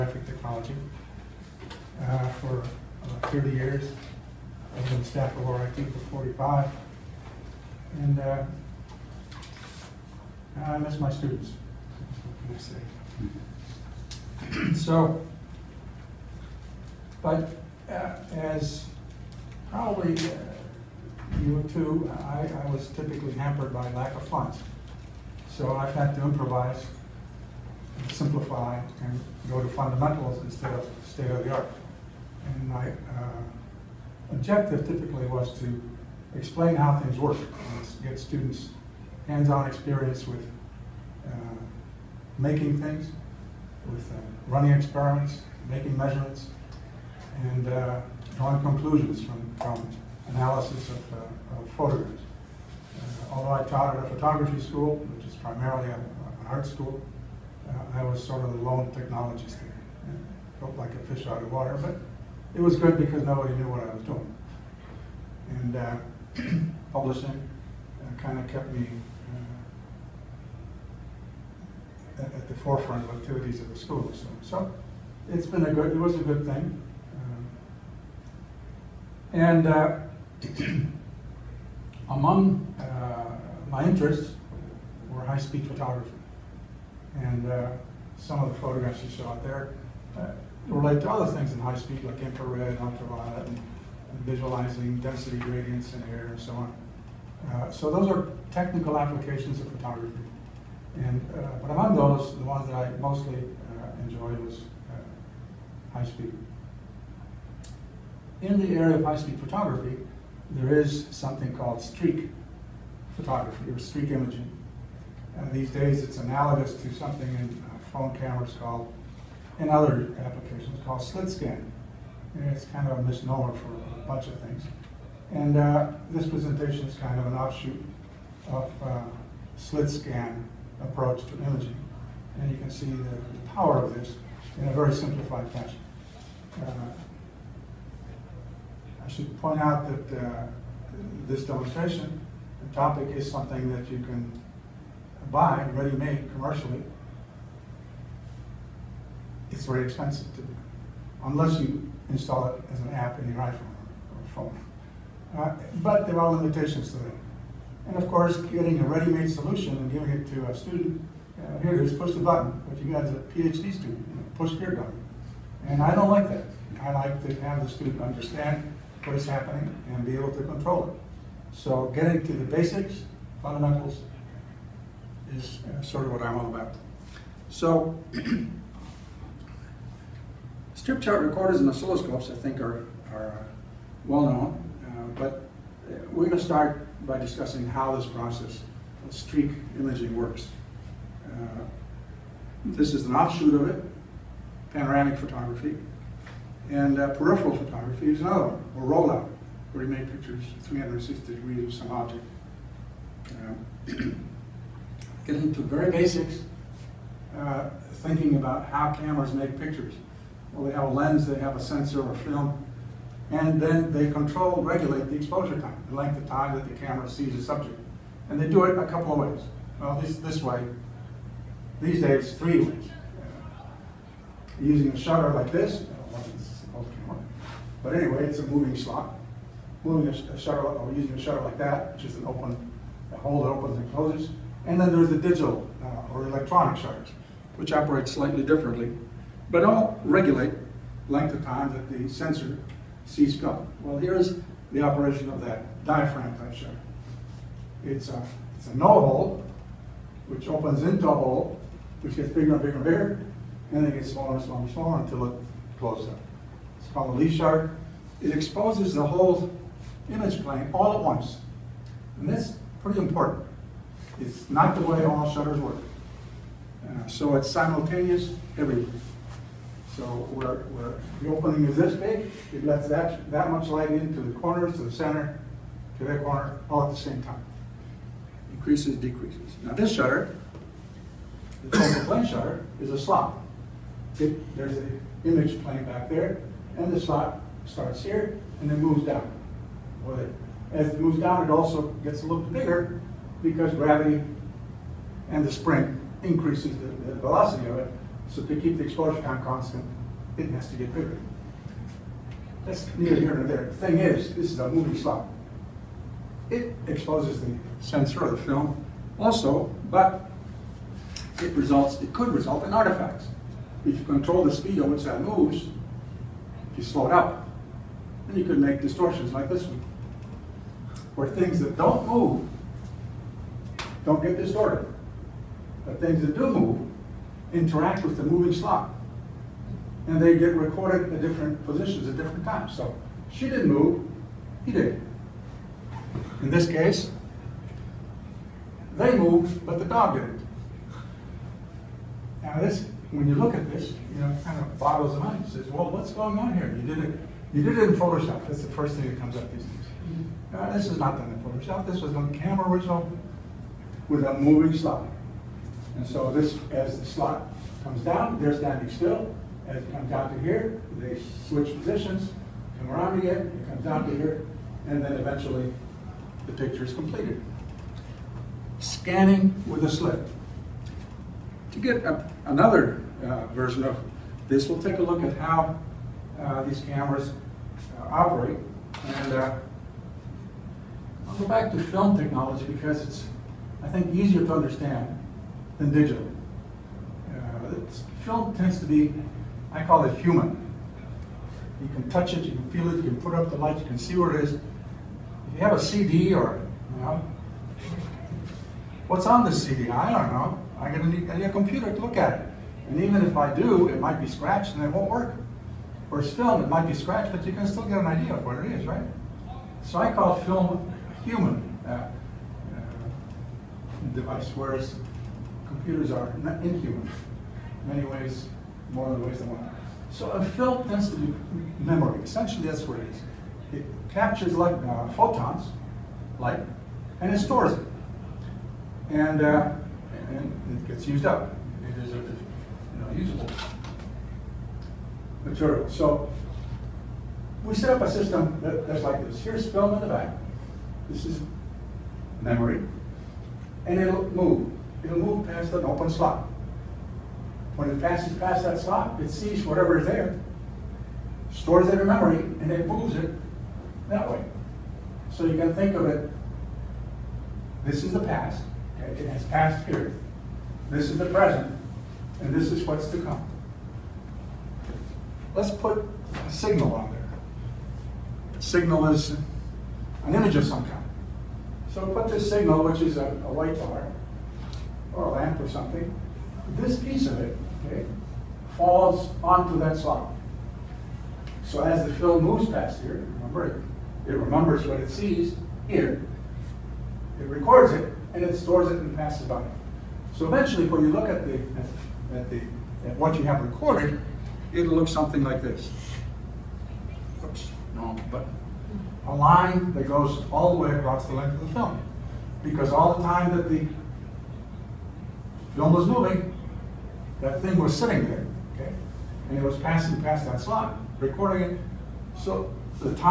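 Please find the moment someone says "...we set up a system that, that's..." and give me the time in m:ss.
7:17.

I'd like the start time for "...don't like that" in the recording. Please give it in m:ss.
2:45.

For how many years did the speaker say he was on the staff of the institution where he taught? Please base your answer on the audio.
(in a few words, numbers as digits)
45.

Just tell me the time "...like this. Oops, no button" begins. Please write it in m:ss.
8:15.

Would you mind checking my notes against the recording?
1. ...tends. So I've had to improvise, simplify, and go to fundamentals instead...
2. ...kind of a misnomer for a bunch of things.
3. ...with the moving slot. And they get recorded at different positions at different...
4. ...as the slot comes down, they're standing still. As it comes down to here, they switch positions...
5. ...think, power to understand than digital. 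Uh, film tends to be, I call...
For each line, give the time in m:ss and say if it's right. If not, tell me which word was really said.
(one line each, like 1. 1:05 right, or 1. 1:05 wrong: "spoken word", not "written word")
1. 0:24 wrong: "funds", not "tends"
2. 2:02 right
3. 5:28 right
4. 5:56 right
5. 6:23 wrong: "easier", not "power".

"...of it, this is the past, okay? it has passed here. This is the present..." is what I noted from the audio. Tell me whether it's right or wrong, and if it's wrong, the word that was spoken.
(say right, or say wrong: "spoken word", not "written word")
right.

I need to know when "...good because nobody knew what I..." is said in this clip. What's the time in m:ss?
1:02.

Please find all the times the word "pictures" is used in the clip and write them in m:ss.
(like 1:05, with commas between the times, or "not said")
3:20, 3:29, 6:06.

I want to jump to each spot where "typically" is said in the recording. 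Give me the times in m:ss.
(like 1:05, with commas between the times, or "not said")
0:22, 0:34.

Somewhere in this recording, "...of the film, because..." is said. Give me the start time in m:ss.
8:21.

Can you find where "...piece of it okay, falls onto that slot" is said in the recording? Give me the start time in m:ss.
7:56.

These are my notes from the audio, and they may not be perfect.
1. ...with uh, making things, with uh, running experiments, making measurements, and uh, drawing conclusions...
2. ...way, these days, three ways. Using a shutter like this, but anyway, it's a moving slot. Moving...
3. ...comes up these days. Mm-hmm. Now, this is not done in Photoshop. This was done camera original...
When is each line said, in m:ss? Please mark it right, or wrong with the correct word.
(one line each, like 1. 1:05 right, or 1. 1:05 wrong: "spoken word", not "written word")
1. 0:40 right
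2. 3:40 right
3. 5:49 right.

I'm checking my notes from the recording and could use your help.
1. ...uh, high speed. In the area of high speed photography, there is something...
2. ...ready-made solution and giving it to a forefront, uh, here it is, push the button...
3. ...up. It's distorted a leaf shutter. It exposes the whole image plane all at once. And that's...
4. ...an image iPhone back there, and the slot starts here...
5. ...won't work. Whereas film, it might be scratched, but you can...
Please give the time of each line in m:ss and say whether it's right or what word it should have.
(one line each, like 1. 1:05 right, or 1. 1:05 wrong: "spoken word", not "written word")
1. 1:44 right
2. 2:38 wrong: "student", not "forefront"
3. 4:16 wrong: "called", not "distorted"
4. 4:44 wrong: "plane", not "iPhone"
5. 6:44 right.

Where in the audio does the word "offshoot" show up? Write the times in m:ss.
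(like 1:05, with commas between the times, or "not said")
2:07, 3:13.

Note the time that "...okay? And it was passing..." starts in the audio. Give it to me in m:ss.
8:28.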